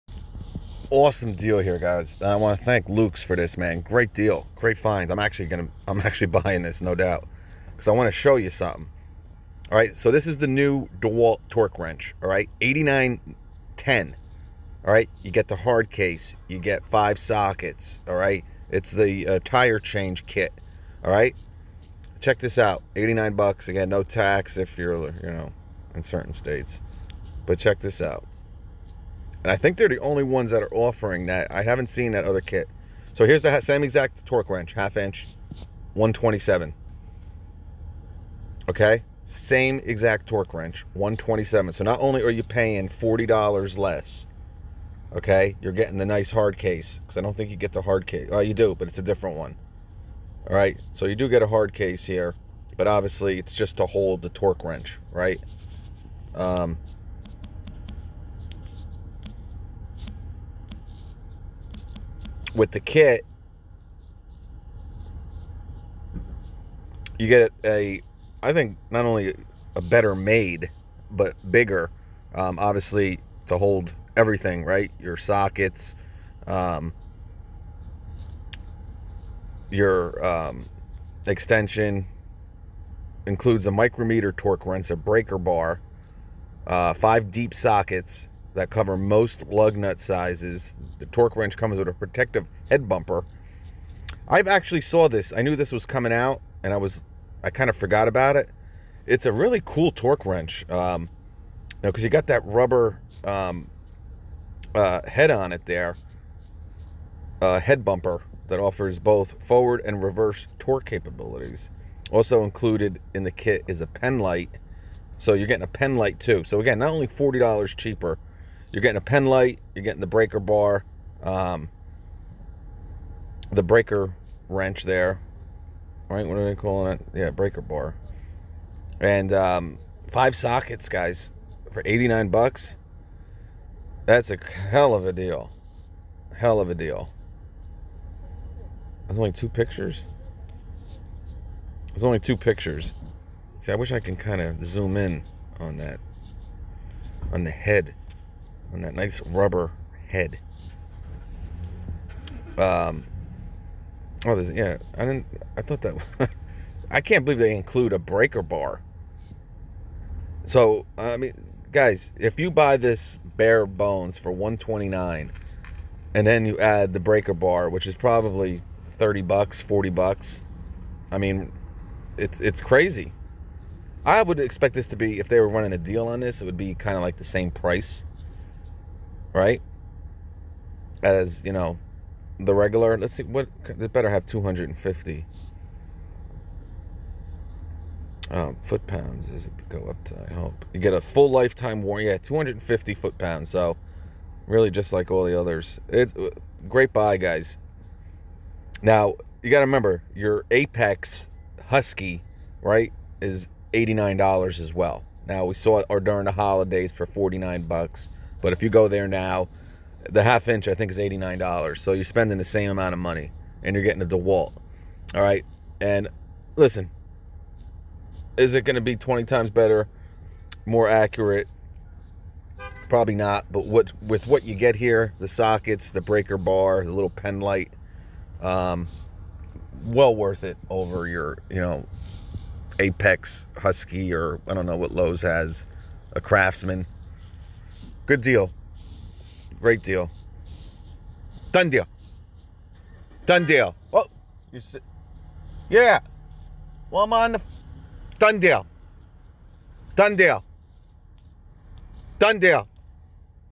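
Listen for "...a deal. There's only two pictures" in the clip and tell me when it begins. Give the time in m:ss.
2:16.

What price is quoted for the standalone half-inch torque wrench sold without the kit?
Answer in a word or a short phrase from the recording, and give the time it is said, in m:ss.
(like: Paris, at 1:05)
127, at 0:35.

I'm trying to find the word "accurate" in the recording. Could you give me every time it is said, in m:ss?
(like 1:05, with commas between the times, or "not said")
3:40.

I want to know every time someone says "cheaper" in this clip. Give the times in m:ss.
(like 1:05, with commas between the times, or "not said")
1:57.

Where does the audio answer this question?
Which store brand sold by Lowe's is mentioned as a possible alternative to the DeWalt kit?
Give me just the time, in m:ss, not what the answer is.
3:56.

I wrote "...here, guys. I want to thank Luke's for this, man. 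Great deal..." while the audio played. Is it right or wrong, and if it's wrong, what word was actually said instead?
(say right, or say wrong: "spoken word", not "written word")
right.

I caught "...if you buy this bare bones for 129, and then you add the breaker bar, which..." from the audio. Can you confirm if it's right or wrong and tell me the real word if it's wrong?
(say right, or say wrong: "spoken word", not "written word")
right.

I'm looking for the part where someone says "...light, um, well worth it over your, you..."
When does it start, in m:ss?
3:47.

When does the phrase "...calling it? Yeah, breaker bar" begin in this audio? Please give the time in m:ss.
2:06.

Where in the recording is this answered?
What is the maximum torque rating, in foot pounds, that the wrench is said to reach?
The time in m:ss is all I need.
3:04.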